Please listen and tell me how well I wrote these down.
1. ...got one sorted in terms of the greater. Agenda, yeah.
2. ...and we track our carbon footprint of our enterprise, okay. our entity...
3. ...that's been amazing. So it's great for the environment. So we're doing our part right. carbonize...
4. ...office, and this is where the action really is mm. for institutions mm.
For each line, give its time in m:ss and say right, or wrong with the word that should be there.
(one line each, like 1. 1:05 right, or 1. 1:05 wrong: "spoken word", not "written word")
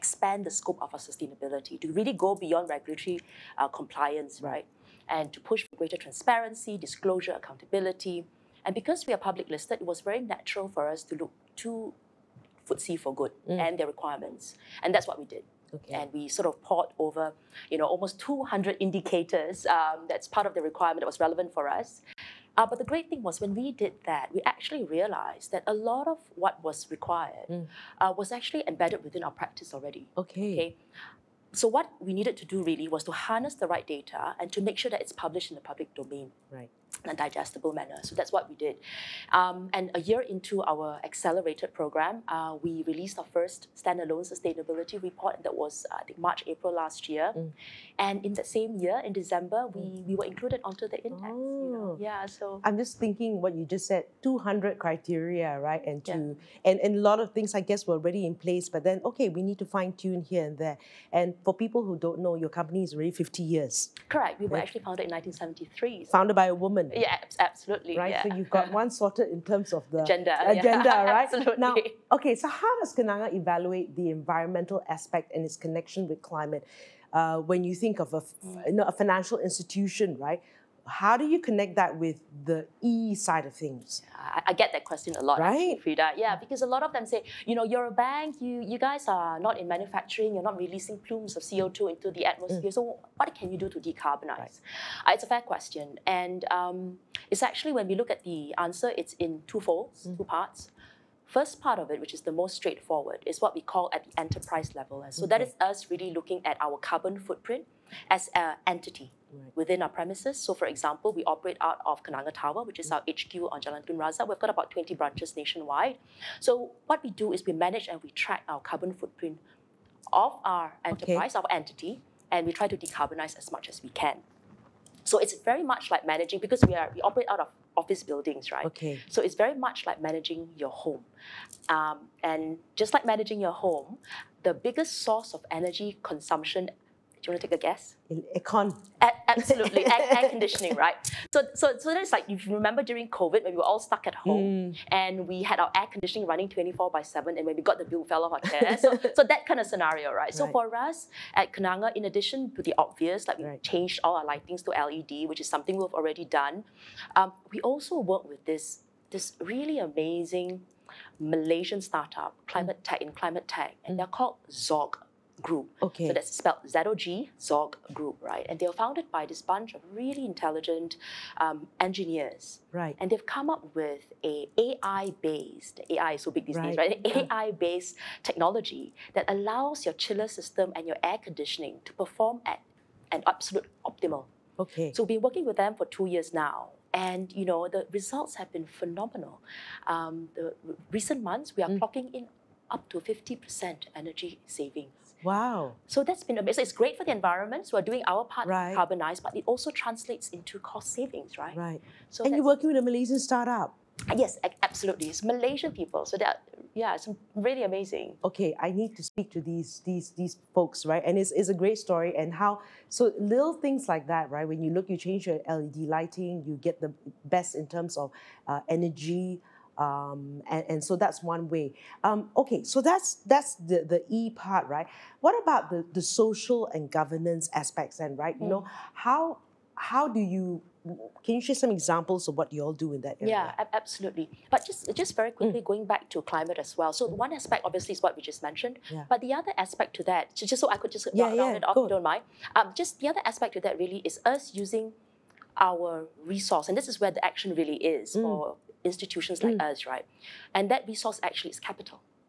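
1. 1:08 wrong: "gender", not "greater"
2. 1:57 right
3. 3:16 right
4. 4:06 wrong: "resource", not "office".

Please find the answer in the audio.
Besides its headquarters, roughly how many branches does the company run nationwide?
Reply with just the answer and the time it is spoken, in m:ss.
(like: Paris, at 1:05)
20, at 1:54.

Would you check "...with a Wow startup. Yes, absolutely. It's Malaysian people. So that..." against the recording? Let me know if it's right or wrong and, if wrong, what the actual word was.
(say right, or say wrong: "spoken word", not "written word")
wrong: "Malaysian", not "Wow".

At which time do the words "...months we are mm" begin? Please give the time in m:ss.
3:11.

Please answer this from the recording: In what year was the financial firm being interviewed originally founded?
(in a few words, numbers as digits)
1973.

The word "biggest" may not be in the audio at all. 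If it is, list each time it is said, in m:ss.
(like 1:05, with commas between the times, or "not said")
2:14.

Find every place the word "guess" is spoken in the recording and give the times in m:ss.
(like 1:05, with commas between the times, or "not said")
0:57, 2:17.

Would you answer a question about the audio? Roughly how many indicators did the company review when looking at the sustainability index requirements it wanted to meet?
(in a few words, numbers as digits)
200.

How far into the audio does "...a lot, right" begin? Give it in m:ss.
1:25.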